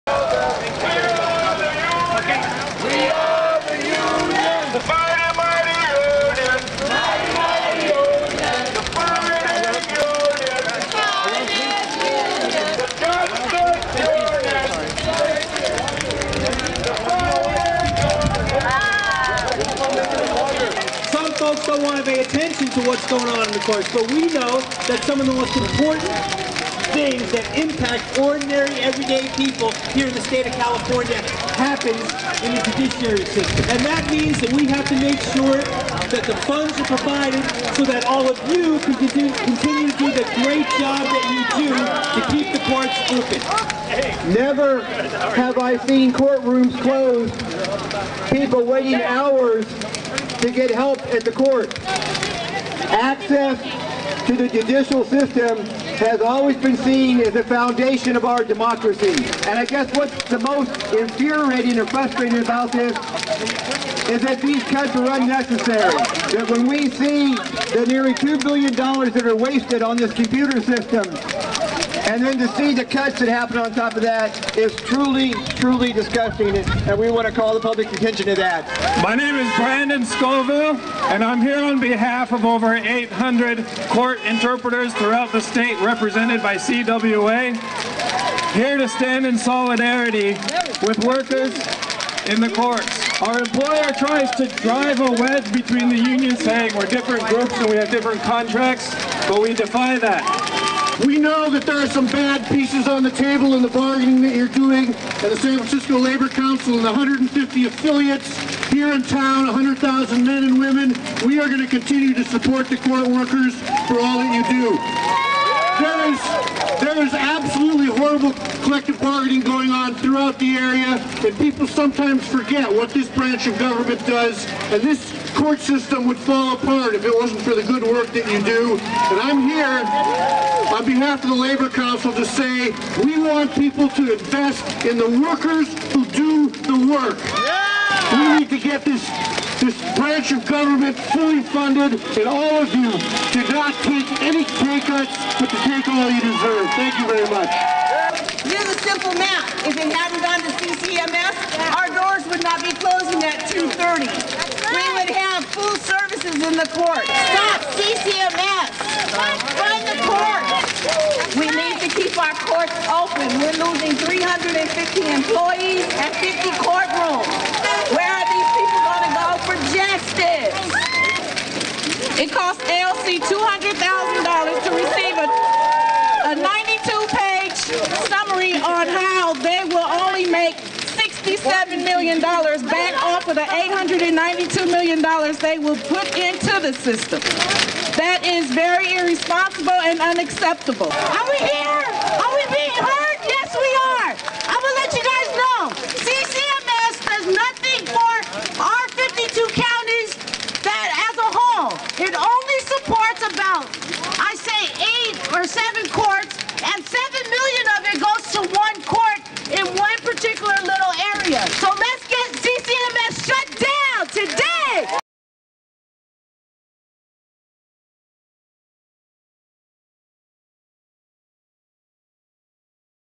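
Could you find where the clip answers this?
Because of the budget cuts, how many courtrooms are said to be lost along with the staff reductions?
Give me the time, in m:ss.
2:46.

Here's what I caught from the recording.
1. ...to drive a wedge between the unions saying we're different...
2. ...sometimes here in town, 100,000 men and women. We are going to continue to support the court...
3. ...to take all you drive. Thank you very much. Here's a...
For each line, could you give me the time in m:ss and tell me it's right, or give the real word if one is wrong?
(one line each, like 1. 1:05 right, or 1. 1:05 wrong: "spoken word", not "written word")
1. 1:34 right
2. 1:47 wrong: "affiliates", not "sometimes"
3. 2:25 wrong: "deserve", not "drive".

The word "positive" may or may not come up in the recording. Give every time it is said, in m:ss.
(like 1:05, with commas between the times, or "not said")
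not said.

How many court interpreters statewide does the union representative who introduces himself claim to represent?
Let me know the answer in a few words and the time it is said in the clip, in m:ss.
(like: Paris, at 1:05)
over 800, at 1:22.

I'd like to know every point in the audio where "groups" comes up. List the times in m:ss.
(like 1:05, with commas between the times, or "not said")
1:37.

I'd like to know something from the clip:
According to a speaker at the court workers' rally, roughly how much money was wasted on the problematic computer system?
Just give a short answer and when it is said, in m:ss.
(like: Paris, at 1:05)
nearly $2 billion, at 1:07.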